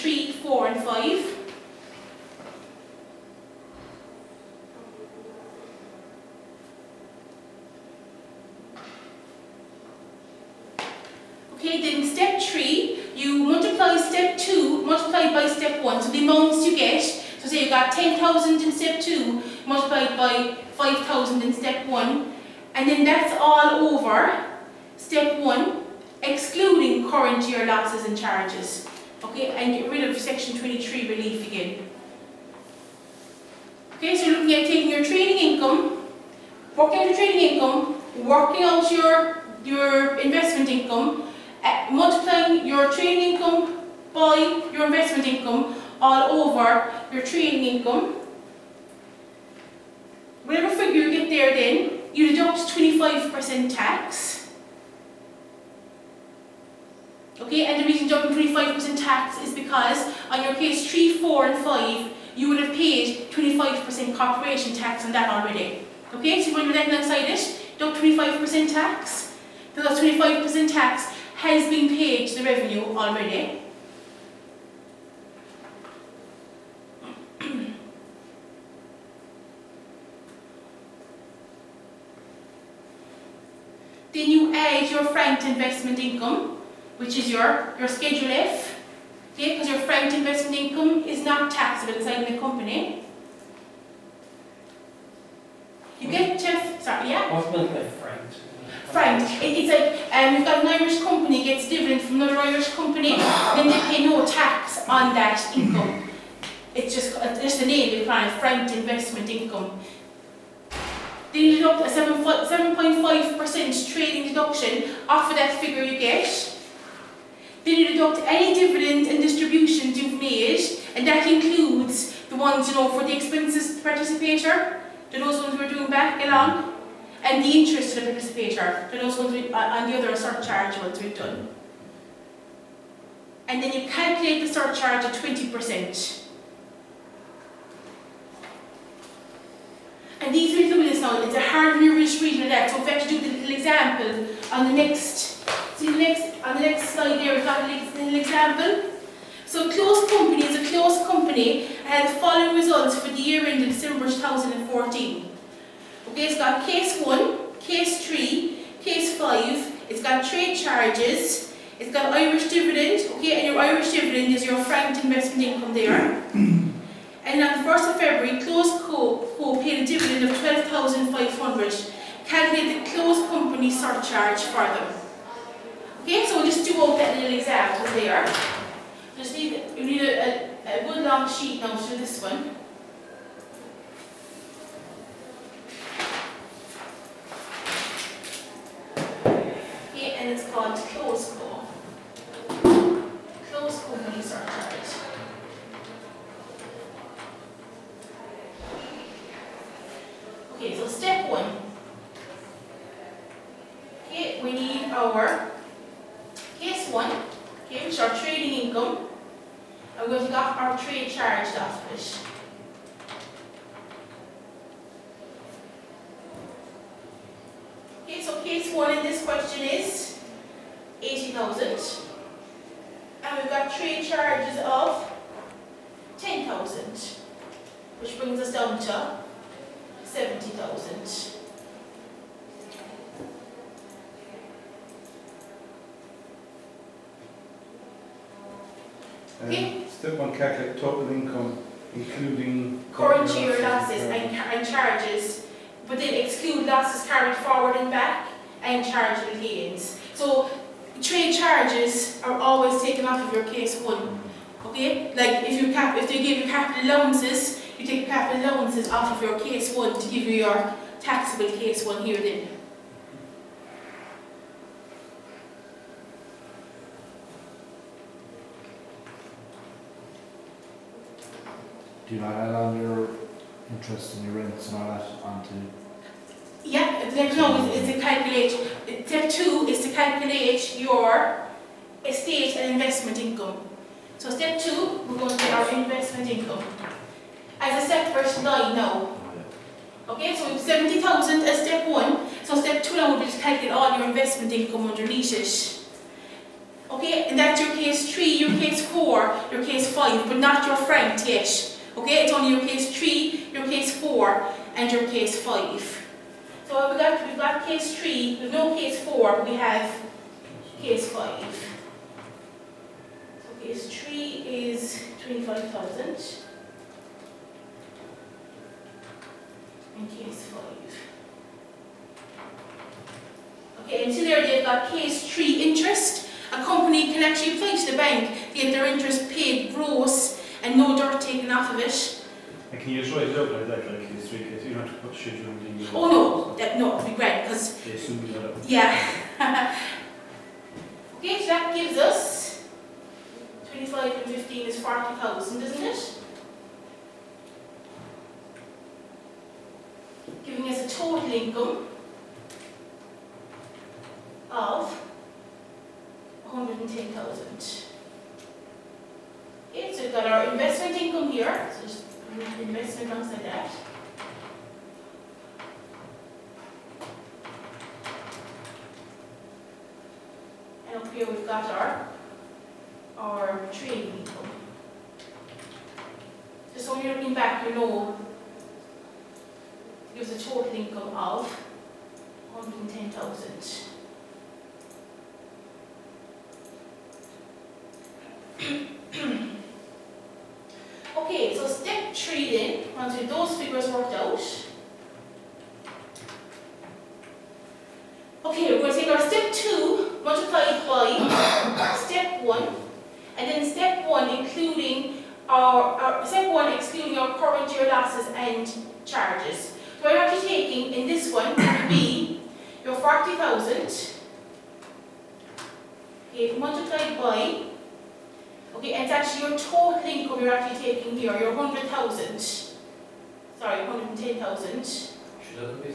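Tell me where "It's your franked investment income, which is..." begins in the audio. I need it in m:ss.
1:24.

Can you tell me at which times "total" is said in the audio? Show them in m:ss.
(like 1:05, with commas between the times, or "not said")
5:50, 6:20, 6:59.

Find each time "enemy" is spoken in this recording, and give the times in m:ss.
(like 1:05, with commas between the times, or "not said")
not said.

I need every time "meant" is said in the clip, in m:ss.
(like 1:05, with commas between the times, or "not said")
1:37.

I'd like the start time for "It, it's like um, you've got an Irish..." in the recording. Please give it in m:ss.
1:39.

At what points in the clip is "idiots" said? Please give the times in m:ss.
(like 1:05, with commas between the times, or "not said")
not said.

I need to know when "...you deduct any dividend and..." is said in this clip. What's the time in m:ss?
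1:57.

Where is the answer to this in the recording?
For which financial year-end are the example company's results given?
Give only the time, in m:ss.
2:33.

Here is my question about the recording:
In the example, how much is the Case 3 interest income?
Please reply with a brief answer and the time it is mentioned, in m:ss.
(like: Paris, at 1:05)
25,000, at 5:15.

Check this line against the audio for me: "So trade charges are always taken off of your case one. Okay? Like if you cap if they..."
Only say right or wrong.
right.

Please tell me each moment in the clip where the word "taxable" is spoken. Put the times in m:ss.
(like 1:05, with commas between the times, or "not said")
1:31, 4:20.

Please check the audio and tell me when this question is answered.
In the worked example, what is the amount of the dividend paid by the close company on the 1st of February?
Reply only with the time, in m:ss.
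2:50.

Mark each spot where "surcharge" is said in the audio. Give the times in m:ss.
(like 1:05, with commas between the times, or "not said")
2:10, 2:14, 2:53.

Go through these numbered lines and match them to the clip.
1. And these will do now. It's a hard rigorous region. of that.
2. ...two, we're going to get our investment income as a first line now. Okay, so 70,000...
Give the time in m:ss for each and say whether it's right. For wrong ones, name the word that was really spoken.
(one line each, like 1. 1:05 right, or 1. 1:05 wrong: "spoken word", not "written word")
1. 2:20 right
2. 4:44 right.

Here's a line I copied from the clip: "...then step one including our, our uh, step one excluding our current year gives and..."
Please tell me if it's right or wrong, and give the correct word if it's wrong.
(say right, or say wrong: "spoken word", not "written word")
wrong: "losses", not "gives".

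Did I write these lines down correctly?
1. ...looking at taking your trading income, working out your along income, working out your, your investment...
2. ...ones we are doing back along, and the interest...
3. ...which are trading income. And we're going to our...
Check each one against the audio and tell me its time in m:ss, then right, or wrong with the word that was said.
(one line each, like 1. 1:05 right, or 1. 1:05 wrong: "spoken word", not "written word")
1. 0:34 wrong: "trading", not "along"
2. 2:05 right
3. 3:27 right.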